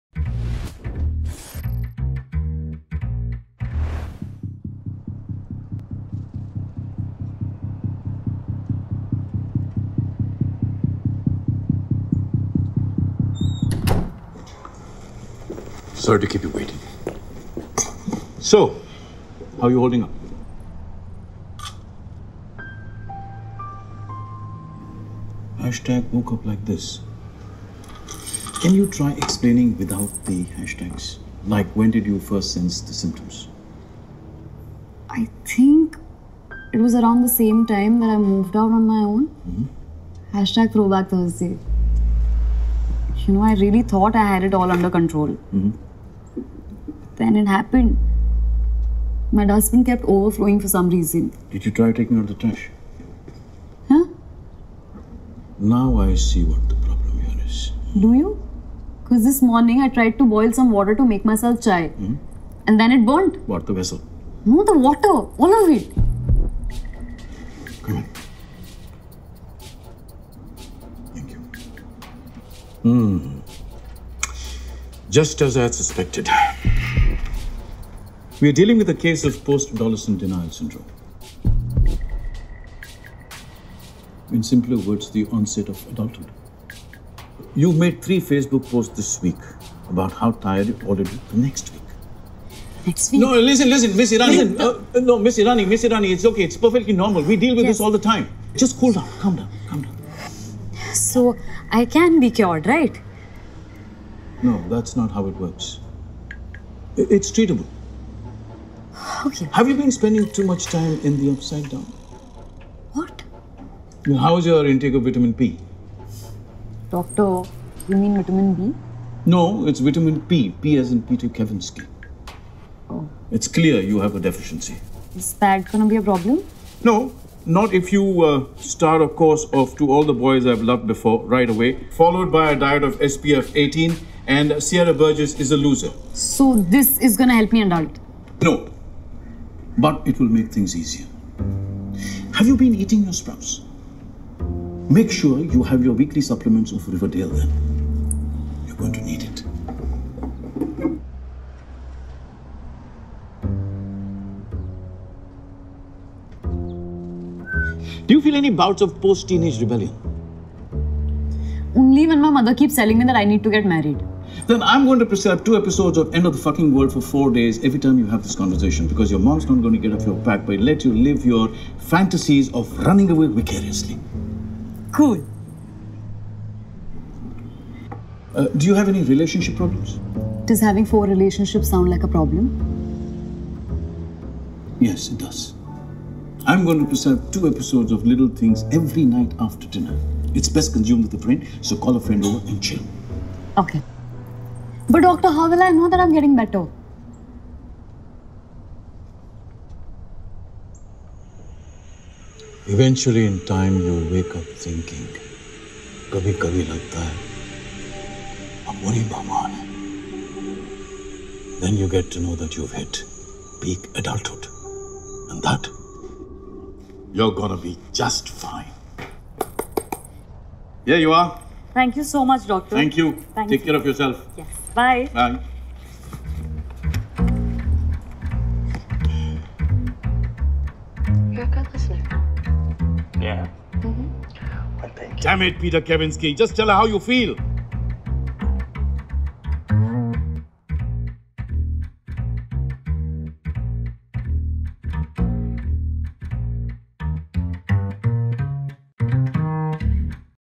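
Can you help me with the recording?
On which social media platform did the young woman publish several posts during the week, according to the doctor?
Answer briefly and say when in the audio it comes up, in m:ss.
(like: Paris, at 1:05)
Facebook, at 1:28.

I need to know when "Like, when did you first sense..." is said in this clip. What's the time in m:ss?
0:31.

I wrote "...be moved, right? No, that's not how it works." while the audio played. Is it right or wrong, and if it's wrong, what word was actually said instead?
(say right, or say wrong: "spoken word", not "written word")
wrong: "cured", not "moved".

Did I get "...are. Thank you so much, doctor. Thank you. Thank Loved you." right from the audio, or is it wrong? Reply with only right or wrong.
wrong.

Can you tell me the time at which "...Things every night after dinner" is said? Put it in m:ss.
3:08.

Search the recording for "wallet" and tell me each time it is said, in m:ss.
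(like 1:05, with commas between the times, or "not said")
not said.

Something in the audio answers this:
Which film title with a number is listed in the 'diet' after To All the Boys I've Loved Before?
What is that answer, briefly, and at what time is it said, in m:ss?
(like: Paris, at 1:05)
SPF 18, at 2:12.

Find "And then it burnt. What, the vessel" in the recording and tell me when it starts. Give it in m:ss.
1:02.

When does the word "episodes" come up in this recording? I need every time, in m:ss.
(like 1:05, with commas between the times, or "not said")
2:45, 3:07.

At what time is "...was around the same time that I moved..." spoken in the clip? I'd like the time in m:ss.
0:36.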